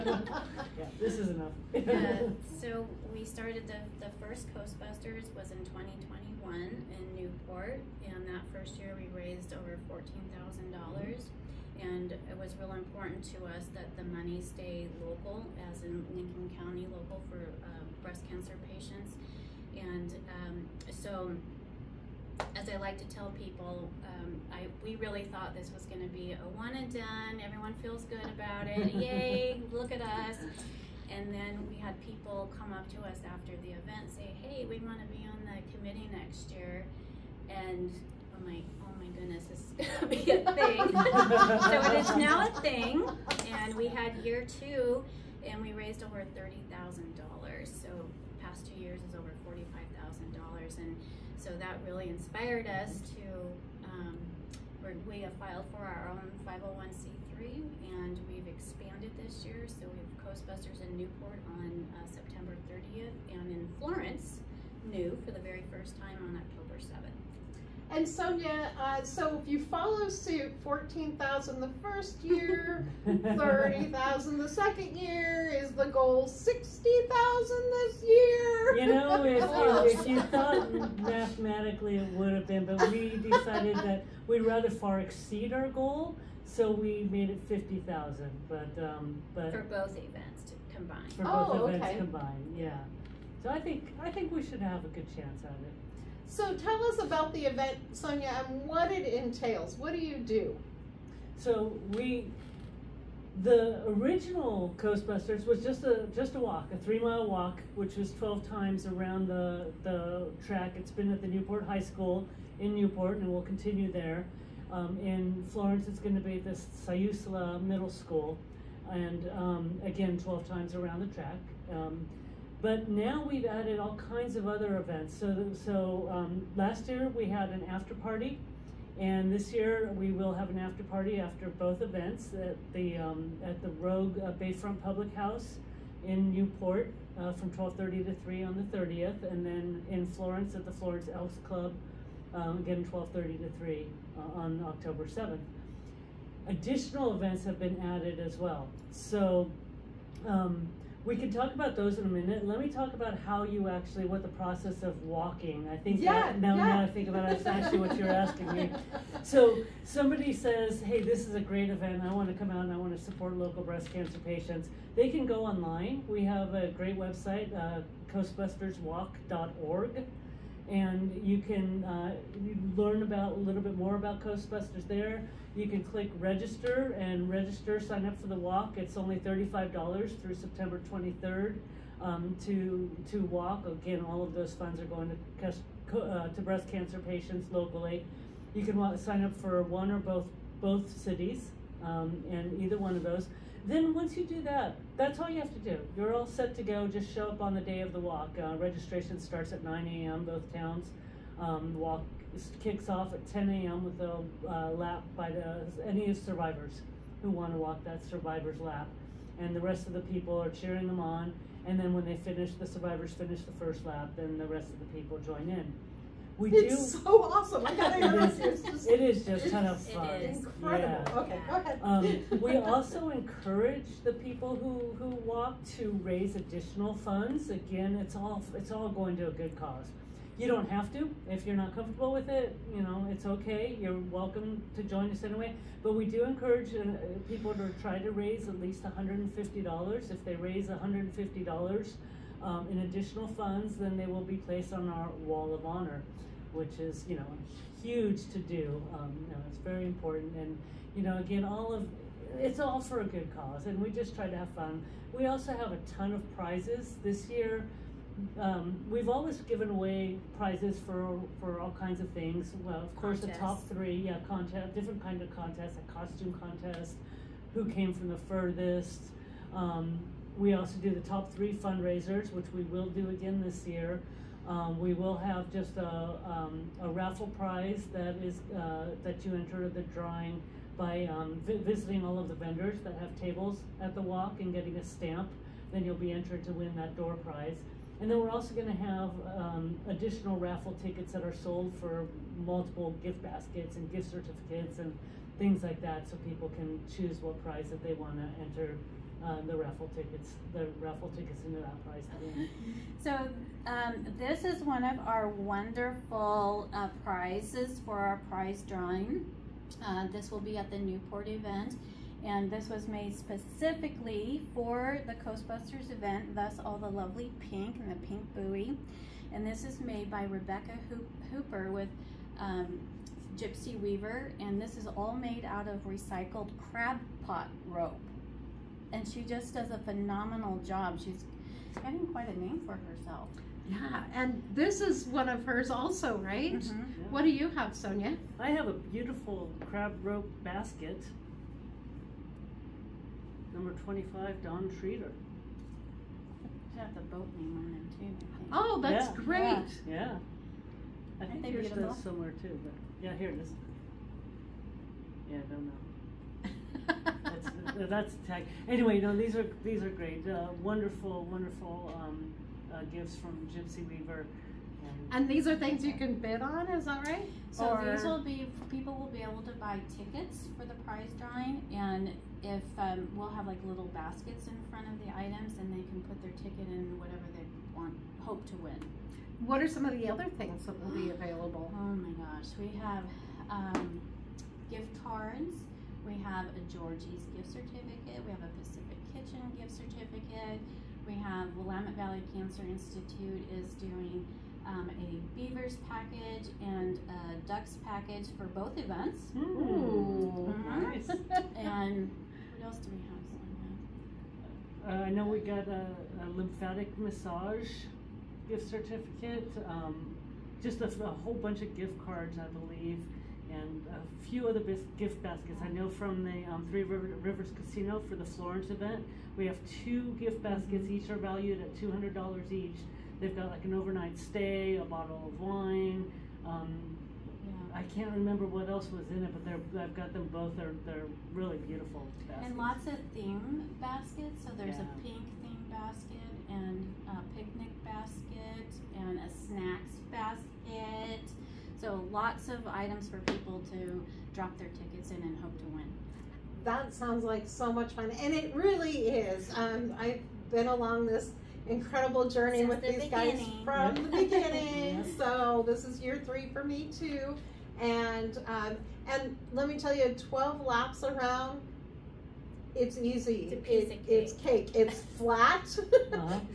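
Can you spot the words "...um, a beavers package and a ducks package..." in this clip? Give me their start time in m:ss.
6:34.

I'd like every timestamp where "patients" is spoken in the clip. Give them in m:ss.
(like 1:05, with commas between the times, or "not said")
0:18, 2:44, 3:06.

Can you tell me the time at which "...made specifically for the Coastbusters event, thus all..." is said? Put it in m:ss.
5:12.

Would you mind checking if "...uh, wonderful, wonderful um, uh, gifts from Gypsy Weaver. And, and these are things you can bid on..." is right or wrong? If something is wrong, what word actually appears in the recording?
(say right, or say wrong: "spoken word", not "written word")
right.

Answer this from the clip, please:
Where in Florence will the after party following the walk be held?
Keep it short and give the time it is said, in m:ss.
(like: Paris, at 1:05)
Florence Elks Club, at 2:20.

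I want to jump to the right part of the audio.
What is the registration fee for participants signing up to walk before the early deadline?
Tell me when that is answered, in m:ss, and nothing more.
2:59.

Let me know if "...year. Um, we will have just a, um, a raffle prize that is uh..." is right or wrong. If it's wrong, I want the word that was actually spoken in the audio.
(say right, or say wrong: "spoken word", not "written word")
right.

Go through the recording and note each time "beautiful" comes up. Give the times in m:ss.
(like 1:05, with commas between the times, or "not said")
5:38, 5:51, 7:11.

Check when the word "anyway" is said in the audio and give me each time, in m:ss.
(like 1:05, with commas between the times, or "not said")
3:55, 5:58.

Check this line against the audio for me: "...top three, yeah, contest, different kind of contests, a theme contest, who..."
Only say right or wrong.
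wrong.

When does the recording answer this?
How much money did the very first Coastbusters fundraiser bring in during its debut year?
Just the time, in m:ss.
0:09.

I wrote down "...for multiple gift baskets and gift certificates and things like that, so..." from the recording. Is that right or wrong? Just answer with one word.
right.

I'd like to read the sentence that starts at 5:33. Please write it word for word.
Yeah, and this is one of hers also, right?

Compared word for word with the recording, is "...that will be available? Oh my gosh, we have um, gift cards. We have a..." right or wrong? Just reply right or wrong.
right.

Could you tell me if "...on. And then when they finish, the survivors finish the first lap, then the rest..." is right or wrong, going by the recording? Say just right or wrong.
right.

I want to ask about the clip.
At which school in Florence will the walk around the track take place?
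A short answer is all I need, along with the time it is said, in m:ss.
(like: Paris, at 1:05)
Siuslaw Middle School, at 1:56.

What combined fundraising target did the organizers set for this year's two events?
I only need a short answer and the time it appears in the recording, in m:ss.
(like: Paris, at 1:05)
$50,000, at 1:27.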